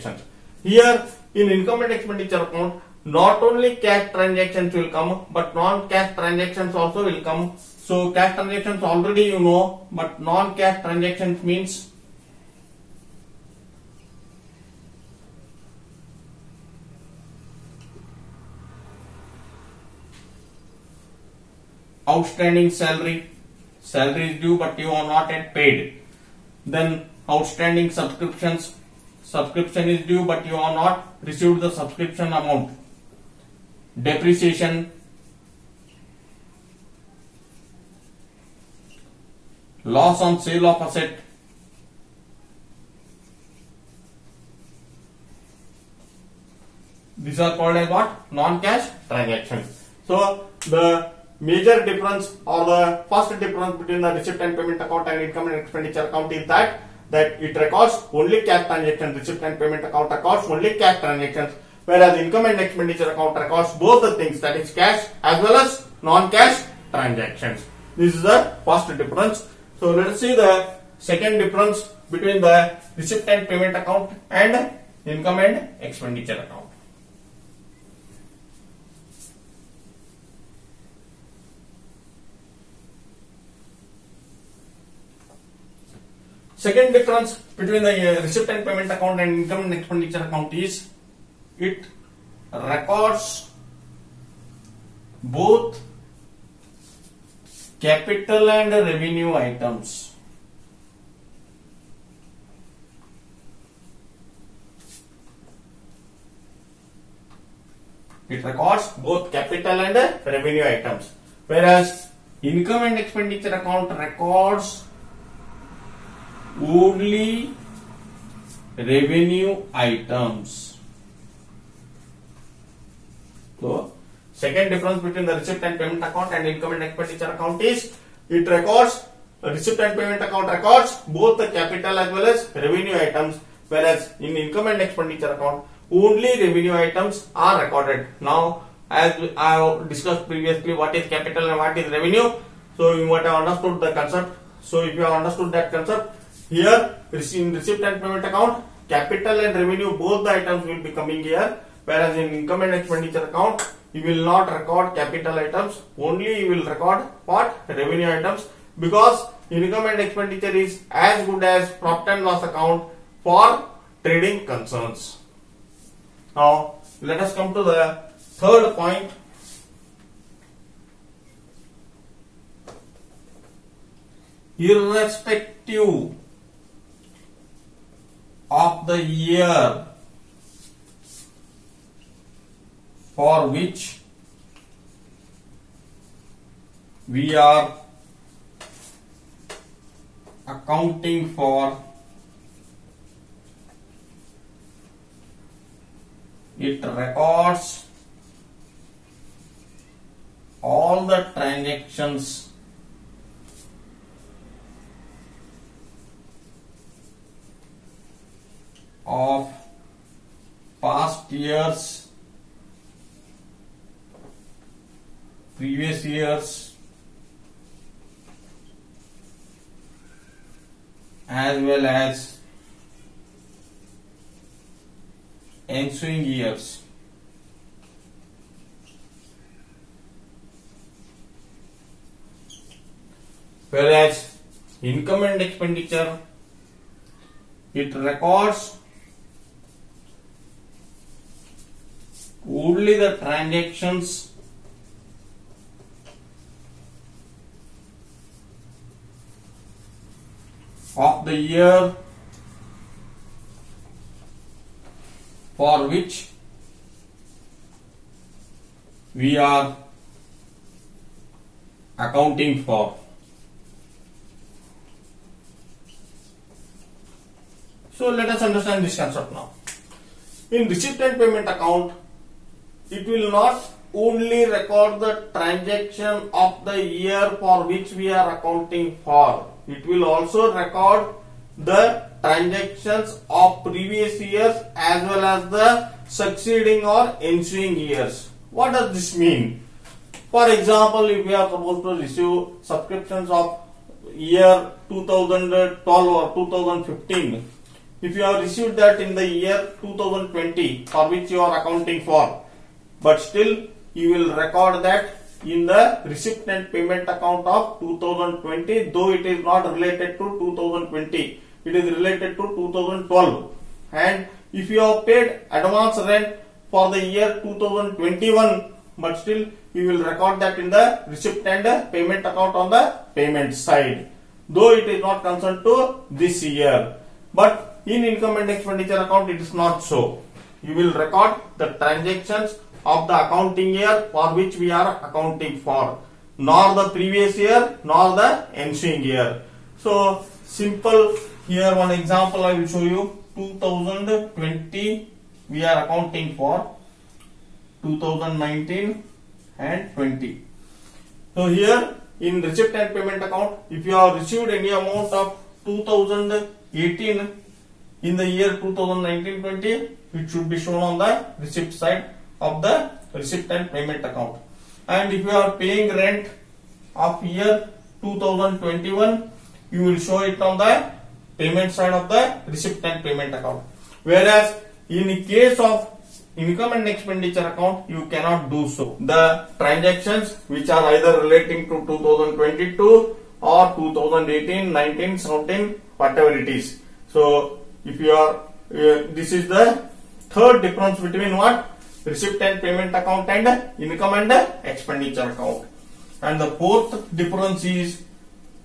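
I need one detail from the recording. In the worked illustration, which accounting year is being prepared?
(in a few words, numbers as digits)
2019-20.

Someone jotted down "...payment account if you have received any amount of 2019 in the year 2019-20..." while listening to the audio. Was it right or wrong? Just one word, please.
wrong.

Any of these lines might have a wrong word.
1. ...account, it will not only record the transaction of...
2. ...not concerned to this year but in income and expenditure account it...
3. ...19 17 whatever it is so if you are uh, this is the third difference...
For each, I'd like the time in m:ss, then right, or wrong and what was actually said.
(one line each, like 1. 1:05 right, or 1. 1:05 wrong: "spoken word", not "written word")
1. 4:31 right
2. 5:25 right
3. 6:24 right.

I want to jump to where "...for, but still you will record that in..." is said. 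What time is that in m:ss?
5:02.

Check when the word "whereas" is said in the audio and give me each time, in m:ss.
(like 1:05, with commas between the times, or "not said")
1:01, 1:51, 2:13, 2:31, 3:53, 6:14.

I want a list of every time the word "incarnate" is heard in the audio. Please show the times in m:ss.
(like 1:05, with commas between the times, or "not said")
not said.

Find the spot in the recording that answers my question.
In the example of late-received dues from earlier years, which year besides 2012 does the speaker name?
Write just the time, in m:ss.
4:56.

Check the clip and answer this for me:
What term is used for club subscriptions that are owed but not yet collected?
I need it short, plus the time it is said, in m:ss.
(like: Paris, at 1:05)
outstanding subscriptions, at 0:27.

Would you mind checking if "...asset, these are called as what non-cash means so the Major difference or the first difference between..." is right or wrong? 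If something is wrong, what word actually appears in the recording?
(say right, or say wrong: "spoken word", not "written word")
wrong: "transactions", not "means".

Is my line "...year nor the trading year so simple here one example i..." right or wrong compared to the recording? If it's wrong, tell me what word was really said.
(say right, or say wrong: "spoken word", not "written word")
wrong: "ensuing", not "trading".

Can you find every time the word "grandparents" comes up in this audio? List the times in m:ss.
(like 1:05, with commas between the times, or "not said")
not said.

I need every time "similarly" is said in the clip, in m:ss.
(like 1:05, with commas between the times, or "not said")
not said.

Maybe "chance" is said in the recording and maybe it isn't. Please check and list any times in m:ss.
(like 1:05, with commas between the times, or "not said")
not said.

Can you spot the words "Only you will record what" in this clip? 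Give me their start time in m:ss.
2:35.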